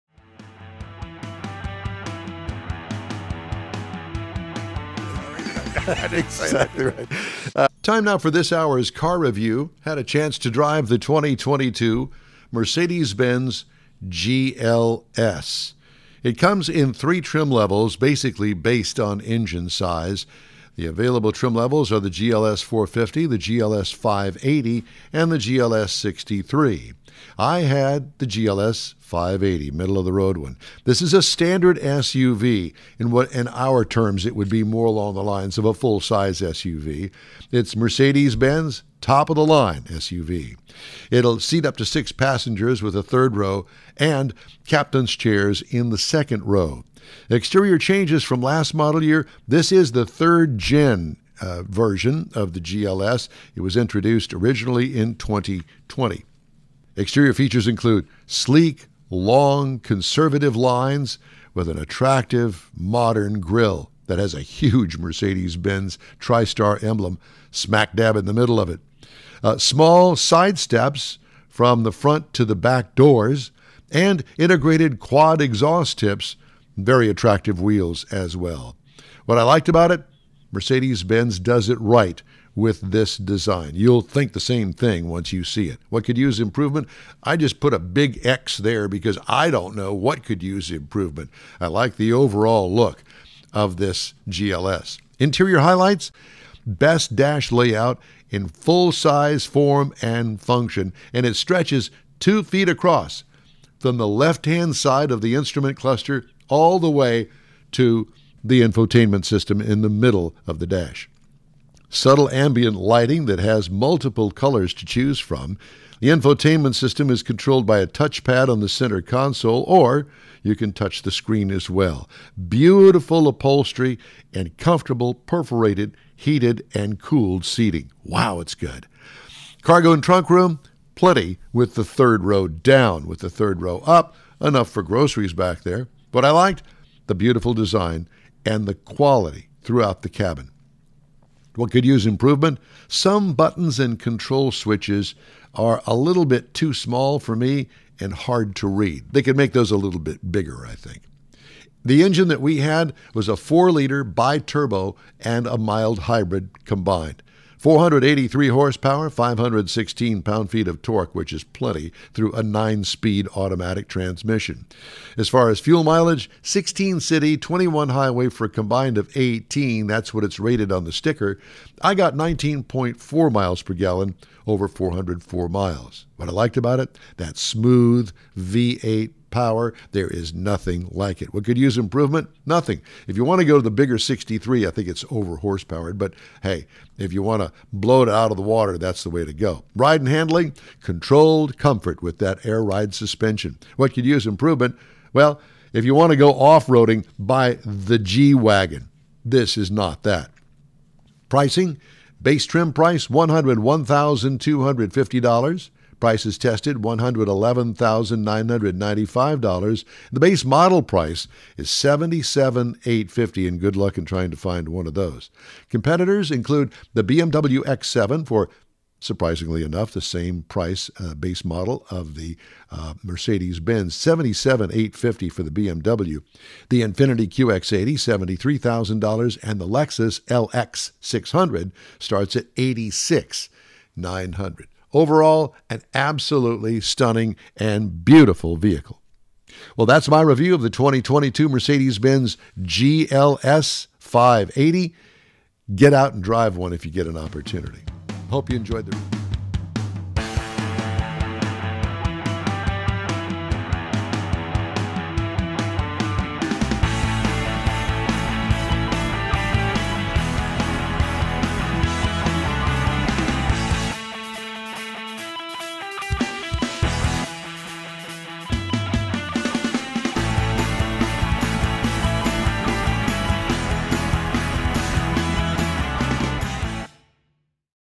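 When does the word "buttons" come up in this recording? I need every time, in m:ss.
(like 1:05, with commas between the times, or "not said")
2:23.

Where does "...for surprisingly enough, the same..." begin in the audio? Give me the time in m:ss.
3:38.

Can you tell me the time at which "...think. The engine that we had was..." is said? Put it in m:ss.
2:30.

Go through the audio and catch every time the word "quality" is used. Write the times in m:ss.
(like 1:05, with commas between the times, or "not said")
2:18.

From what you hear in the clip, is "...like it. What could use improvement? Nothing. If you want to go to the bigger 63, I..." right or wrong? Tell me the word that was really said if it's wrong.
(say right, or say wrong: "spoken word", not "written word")
right.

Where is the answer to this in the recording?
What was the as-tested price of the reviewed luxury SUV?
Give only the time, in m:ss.
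3:26.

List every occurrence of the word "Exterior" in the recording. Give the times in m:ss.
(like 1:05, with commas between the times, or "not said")
0:47, 0:56.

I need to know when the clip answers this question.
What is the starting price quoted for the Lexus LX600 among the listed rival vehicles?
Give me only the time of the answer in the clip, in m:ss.
3:52.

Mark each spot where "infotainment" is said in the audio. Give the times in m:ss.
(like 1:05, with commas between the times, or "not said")
1:48, 1:56.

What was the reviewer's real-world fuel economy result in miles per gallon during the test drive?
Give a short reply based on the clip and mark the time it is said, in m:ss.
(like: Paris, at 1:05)
19.4, at 2:52.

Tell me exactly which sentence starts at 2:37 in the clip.
483 horsepower, 516 pound-feet of torque, which is plenty through a 9-speed automatic transmission.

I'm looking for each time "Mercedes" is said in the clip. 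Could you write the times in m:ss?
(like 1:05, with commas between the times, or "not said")
0:12, 0:37, 1:04, 1:20, 3:43, 4:01.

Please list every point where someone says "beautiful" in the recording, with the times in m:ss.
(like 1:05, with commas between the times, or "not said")
2:02, 2:17, 3:58.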